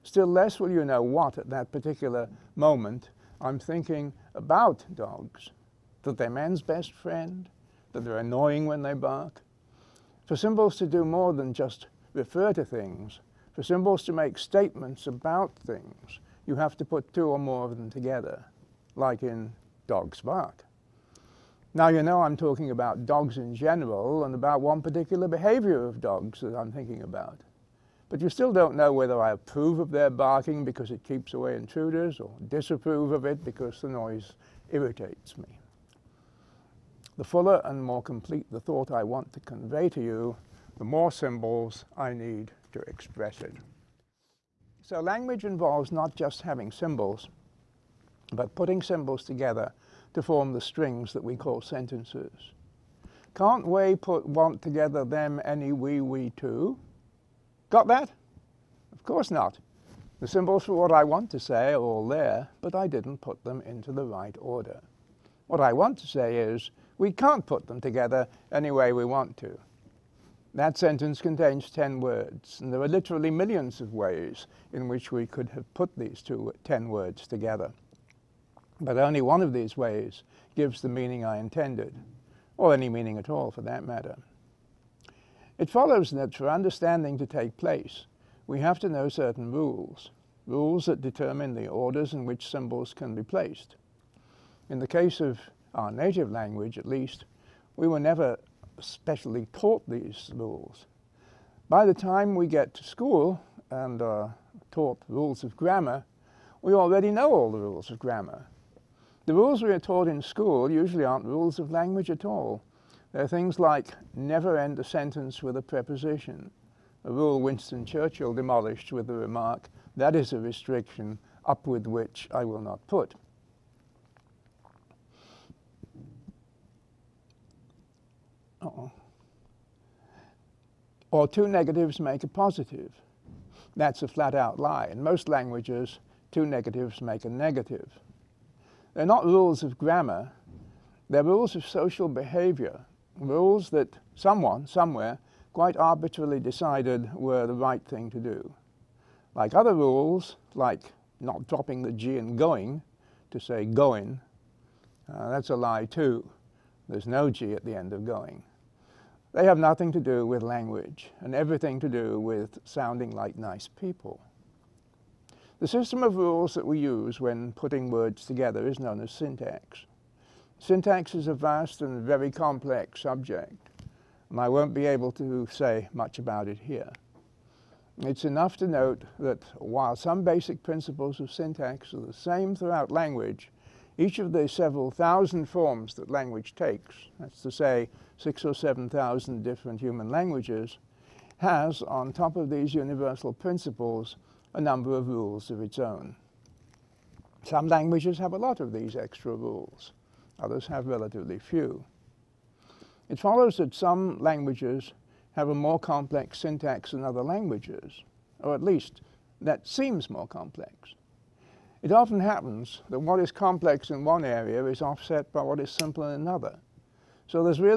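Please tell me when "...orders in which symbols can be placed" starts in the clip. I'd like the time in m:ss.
1:31.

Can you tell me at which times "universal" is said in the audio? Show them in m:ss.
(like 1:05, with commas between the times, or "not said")
3:12.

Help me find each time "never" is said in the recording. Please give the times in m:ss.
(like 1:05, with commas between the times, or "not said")
1:37, 1:54.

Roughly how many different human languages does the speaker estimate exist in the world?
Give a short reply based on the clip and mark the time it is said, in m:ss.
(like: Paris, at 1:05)
6,000 or 7,000, at 3:08.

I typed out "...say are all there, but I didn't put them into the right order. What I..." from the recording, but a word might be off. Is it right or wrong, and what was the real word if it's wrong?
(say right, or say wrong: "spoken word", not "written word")
right.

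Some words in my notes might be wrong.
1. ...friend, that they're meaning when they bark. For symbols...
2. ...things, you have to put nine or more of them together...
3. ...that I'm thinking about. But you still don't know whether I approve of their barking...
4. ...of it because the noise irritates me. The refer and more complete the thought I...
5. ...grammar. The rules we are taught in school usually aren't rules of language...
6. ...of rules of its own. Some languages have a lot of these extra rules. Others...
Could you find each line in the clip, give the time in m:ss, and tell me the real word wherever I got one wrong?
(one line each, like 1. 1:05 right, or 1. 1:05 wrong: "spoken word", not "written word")
1. 0:06 wrong: "annoying", not "meaning"
2. 0:15 wrong: "two", not "nine"
3. 0:26 right
4. 0:33 wrong: "fuller", not "refer"
5. 1:47 right
6. 3:14 right.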